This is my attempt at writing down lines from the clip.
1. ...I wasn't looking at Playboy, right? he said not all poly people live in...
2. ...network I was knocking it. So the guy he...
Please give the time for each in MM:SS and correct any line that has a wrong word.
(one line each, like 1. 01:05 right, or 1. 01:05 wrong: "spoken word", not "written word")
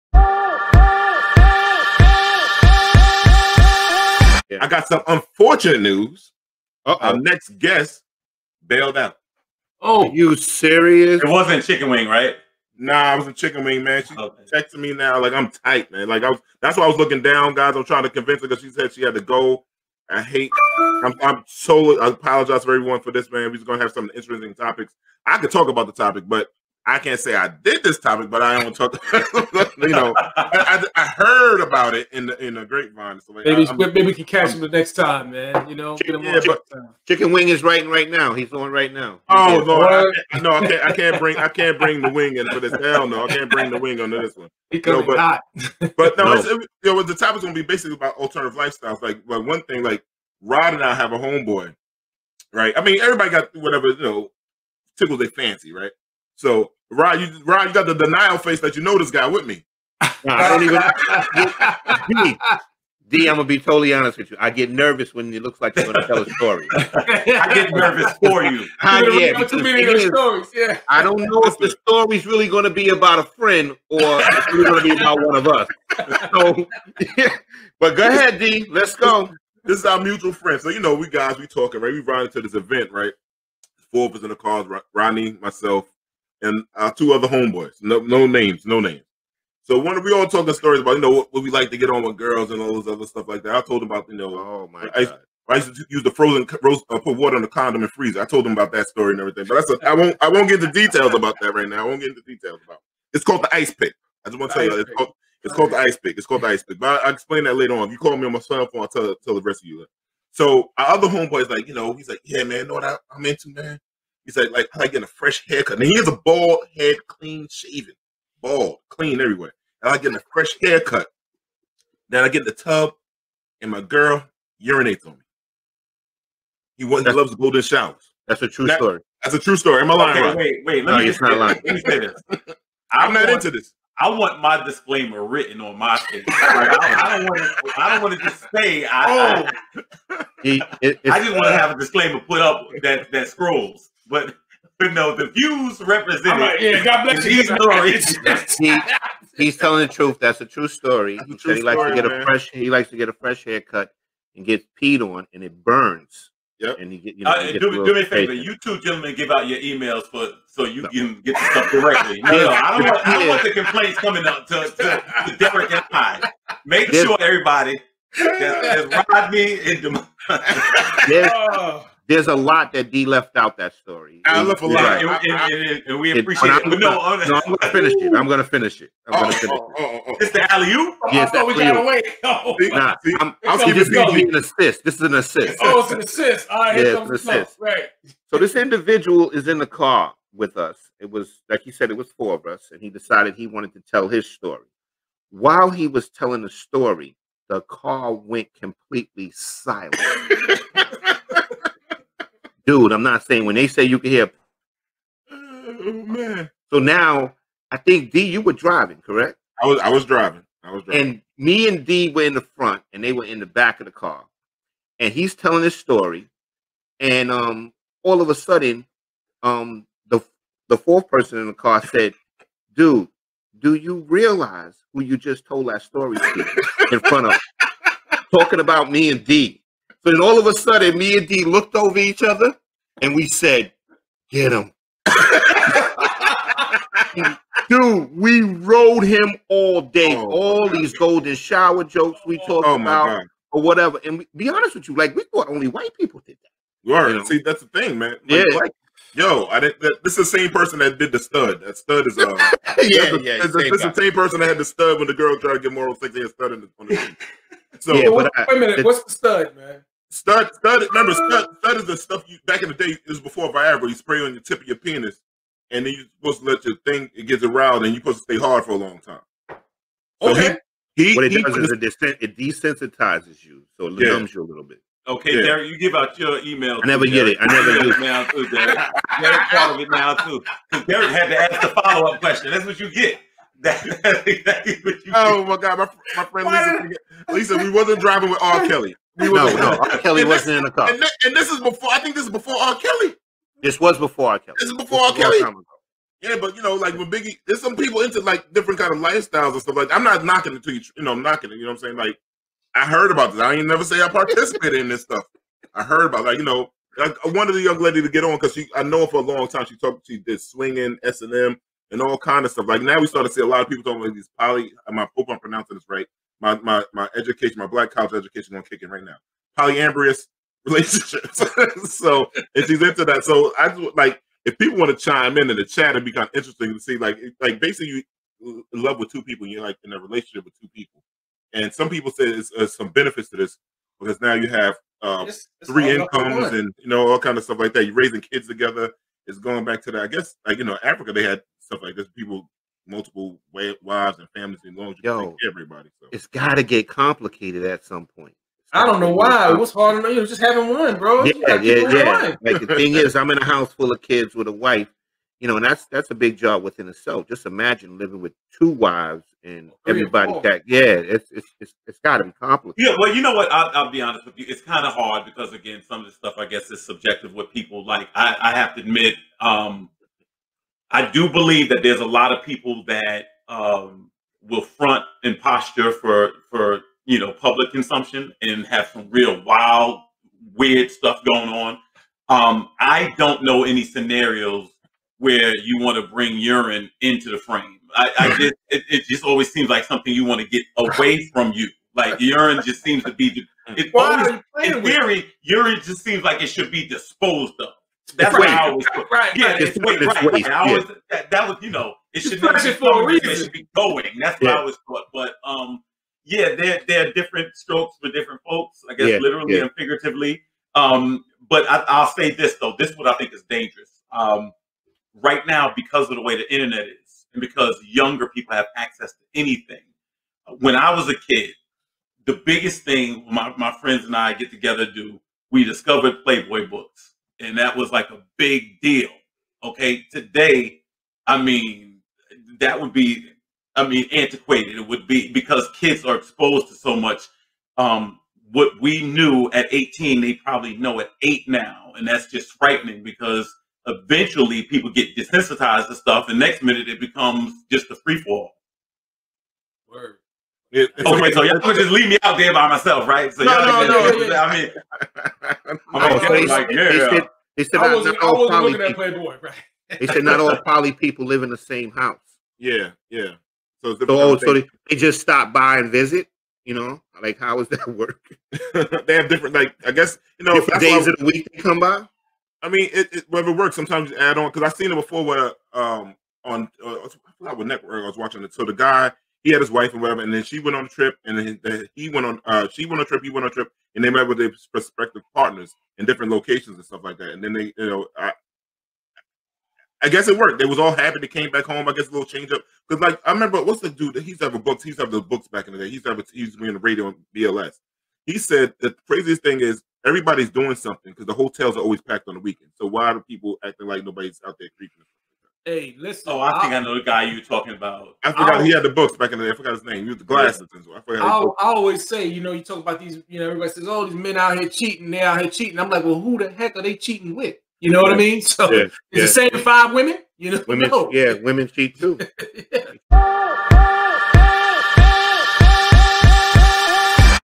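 1. 07:38 right
2. 07:57 wrong: "watching", not "knocking".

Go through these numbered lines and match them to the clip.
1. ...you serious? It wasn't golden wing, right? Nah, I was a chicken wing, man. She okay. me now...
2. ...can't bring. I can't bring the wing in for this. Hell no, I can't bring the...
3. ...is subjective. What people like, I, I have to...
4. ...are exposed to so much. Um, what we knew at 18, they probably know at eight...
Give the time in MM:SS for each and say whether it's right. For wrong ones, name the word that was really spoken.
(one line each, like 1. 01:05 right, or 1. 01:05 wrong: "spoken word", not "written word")
1. 00:10 wrong: "chicken", not "golden"
2. 00:40 right
3. 06:06 right
4. 07:16 right.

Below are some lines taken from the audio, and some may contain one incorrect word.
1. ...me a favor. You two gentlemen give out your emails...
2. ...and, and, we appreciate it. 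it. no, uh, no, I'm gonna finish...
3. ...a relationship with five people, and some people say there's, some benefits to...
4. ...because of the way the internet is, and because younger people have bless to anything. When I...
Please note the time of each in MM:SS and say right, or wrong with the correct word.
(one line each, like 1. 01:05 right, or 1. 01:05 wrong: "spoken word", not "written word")
1. 02:37 right
2. 02:55 right
3. 05:29 wrong: "two", not "five"
4. 06:55 wrong: "access", not "bless".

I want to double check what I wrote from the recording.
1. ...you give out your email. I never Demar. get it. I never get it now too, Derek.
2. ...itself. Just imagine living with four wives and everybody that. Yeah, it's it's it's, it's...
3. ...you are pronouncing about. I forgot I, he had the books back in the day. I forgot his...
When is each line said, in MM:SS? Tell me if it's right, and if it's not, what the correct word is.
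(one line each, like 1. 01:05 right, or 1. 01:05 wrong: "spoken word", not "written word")
1. 04:35 wrong: "Derek", not "Demar"
2. 05:56 wrong: "two", not "four"
3. 08:27 wrong: "talking", not "pronouncing".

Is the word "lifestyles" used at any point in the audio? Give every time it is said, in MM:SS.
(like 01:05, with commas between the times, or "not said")
00:48, 04:58.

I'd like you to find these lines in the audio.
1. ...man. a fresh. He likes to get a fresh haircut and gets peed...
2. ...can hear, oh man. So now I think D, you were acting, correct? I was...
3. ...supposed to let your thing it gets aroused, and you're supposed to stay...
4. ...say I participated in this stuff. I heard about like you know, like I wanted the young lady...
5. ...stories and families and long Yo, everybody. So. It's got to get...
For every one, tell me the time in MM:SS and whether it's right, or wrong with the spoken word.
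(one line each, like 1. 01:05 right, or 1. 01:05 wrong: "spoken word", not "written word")
1. 02:32 right
2. 03:23 wrong: "driving", not "acting"
3. 04:26 right
4. 05:03 right
5. 05:43 wrong: "wives", not "stories".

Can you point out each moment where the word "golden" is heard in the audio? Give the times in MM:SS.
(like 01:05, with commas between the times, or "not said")
02:07, 04:00.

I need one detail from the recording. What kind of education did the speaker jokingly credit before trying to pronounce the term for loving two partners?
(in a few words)
Black college.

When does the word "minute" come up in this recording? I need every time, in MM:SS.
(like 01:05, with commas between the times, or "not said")
04:18, 07:26.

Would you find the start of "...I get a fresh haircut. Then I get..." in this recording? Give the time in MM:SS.
01:59.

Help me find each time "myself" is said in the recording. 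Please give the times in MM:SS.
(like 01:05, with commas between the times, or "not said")
01:25, 07:32.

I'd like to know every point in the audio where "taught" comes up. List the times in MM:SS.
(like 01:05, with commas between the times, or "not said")
06:44.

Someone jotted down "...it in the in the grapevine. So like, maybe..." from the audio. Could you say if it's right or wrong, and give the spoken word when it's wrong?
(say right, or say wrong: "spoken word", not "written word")
right.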